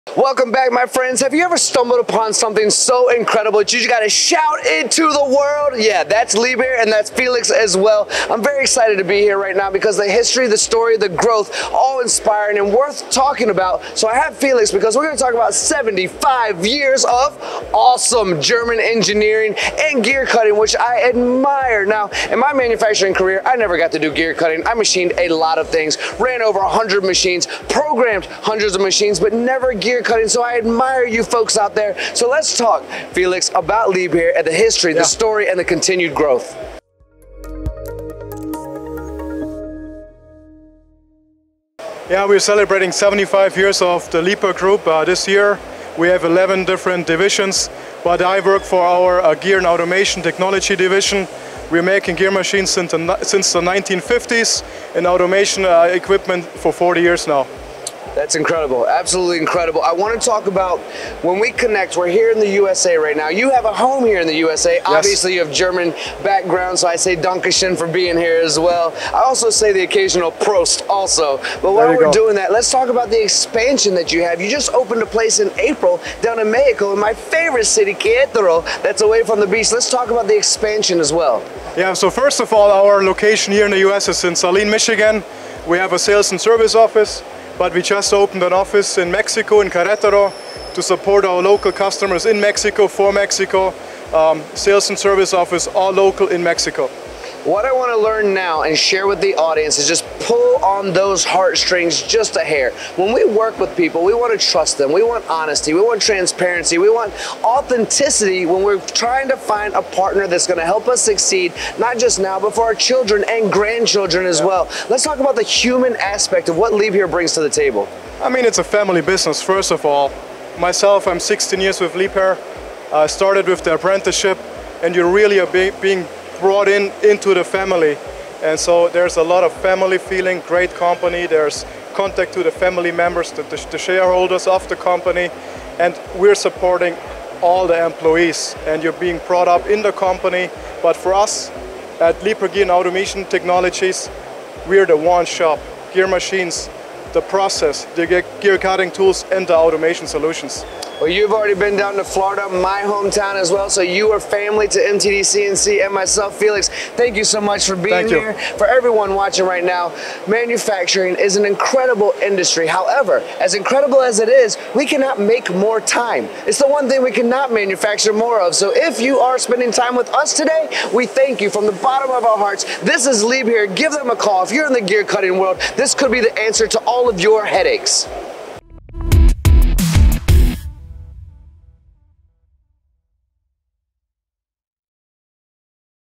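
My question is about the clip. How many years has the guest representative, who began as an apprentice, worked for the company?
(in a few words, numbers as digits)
16.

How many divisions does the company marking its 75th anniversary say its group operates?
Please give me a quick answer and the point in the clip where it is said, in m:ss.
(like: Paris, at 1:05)
11, at 0:46.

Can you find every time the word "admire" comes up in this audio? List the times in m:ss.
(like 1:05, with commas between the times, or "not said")
0:21, 0:30.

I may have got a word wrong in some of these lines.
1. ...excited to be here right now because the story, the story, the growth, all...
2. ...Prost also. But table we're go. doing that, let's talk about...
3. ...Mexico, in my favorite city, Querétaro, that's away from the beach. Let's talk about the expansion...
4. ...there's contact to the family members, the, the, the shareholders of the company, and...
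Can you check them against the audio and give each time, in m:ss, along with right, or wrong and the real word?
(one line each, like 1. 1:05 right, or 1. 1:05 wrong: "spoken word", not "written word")
1. 0:08 wrong: "history", not "story"
2. 1:10 wrong: "while", not "table"
3. 1:16 right
4. 2:11 right.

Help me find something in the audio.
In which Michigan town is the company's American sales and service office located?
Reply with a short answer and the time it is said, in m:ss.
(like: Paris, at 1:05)
Saline, at 1:24.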